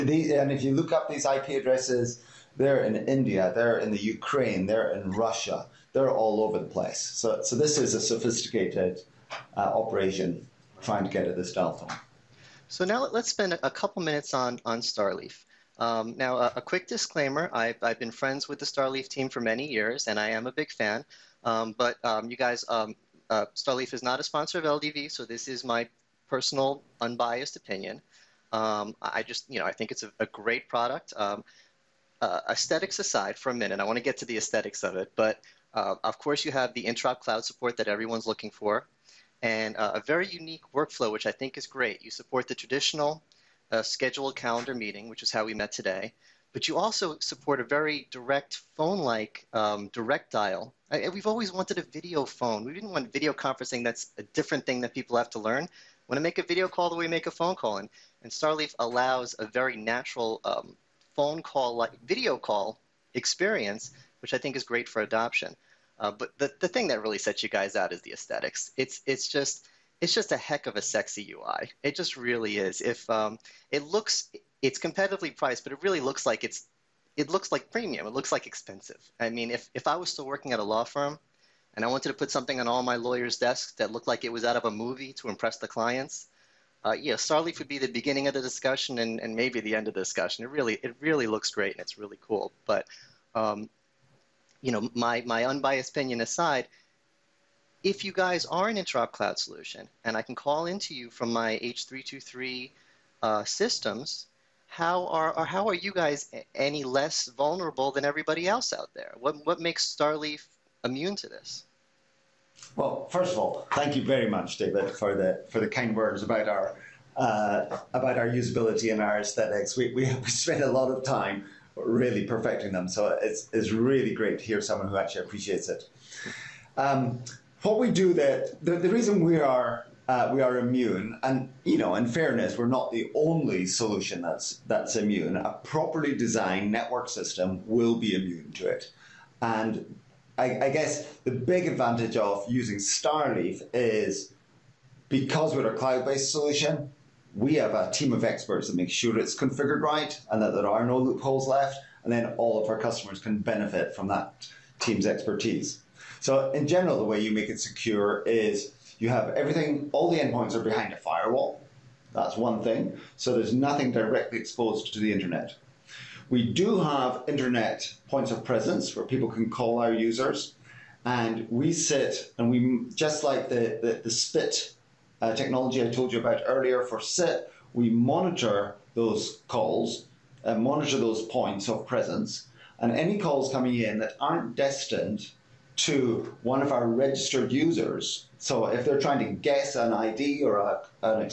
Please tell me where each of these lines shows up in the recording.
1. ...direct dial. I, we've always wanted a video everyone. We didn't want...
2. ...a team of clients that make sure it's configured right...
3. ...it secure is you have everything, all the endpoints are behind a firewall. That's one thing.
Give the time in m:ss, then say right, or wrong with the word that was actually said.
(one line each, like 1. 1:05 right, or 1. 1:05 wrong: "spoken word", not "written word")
1. 0:49 wrong: "phone", not "everyone"
2. 2:27 wrong: "experts", not "clients"
3. 2:37 right.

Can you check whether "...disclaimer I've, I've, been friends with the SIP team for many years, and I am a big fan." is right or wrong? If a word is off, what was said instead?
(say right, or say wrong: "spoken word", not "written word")
wrong: "Starleaf", not "SIP".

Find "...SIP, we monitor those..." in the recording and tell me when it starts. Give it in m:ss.
2:57.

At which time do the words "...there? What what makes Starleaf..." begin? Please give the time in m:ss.
1:48.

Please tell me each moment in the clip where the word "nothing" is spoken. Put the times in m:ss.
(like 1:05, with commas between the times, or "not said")
2:43.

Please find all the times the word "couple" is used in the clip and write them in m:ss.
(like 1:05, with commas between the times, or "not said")
0:13.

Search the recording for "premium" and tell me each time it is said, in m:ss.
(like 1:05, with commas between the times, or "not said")
1:17.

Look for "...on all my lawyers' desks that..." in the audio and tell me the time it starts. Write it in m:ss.
1:22.